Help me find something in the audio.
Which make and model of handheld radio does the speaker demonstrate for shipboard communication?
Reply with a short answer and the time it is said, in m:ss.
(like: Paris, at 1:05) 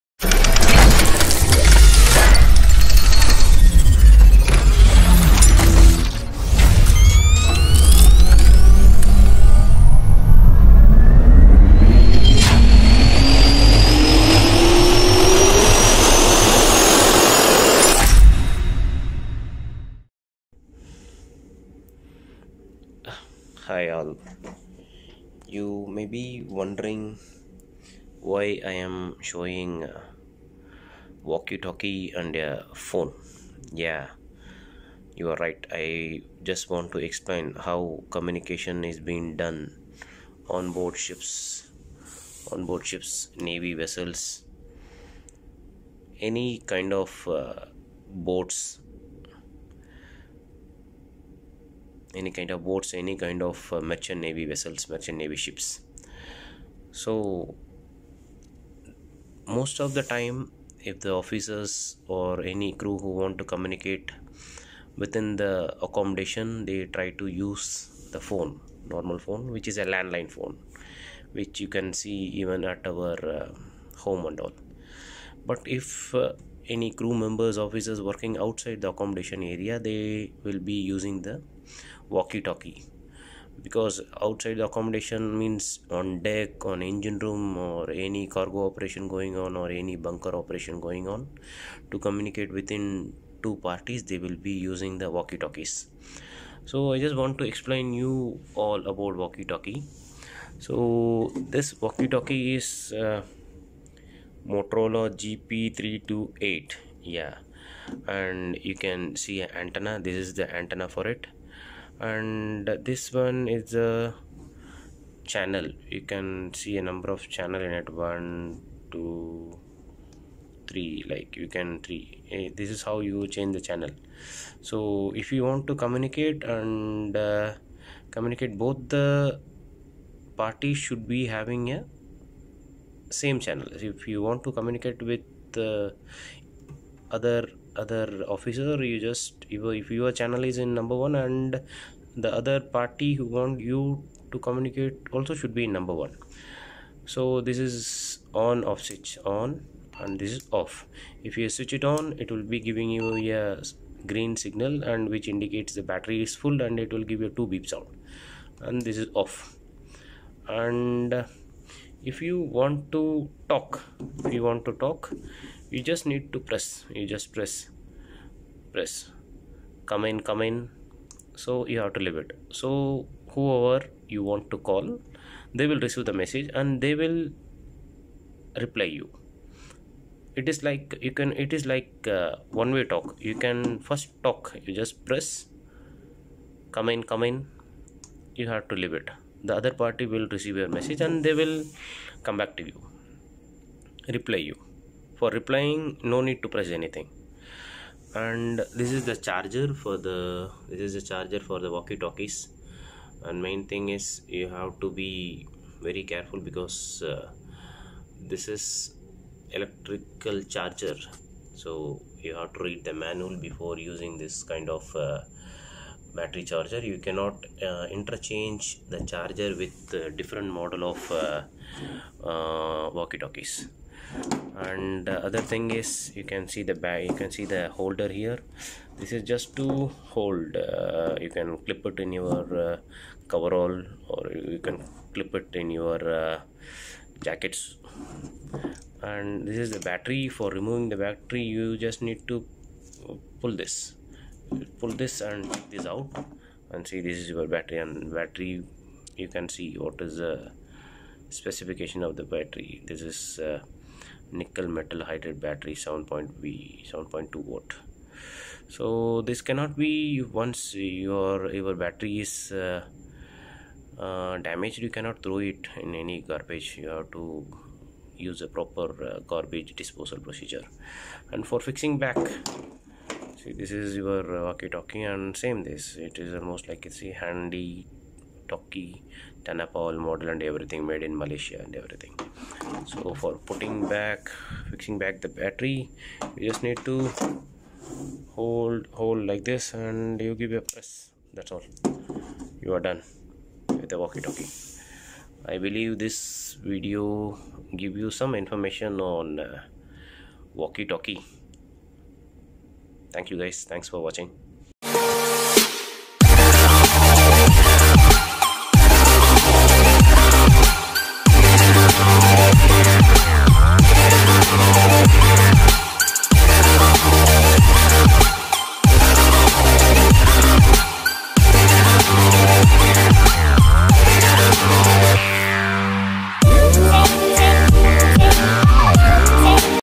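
Motorola GP328, at 1:44.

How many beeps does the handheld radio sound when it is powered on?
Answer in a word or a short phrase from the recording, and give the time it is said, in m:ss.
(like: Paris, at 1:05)
2, at 2:37.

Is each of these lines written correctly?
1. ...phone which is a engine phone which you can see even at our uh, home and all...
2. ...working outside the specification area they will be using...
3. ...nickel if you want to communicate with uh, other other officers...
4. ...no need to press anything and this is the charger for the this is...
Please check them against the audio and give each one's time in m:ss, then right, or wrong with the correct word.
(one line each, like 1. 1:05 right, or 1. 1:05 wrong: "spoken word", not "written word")
1. 1:09 wrong: "landline", not "engine"
2. 1:18 wrong: "accommodation", not "specification"
3. 2:13 wrong: "channel", not "nickel"
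4. 3:16 right.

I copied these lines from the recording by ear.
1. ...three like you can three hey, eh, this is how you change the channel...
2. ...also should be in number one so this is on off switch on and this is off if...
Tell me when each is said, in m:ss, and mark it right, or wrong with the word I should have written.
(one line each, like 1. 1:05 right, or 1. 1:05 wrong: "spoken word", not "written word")
1. 2:00 right
2. 2:25 right.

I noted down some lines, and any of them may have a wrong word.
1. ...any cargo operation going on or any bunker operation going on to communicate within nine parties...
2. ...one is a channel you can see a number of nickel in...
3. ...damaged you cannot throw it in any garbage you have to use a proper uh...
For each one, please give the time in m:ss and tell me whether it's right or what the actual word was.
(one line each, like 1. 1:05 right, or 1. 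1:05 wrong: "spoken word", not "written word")
1. 1:27 wrong: "two", not "nine"
2. 1:53 wrong: "channel", not "nickel"
3. 4:24 right.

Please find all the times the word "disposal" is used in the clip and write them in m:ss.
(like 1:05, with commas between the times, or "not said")
4:29.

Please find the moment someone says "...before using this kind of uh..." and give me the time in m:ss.
3:33.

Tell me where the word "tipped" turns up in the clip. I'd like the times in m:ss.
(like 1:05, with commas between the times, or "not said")
not said.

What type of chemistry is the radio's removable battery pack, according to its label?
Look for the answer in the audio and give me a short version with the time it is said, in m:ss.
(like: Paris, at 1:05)
Nickel metal hydride, at 4:14.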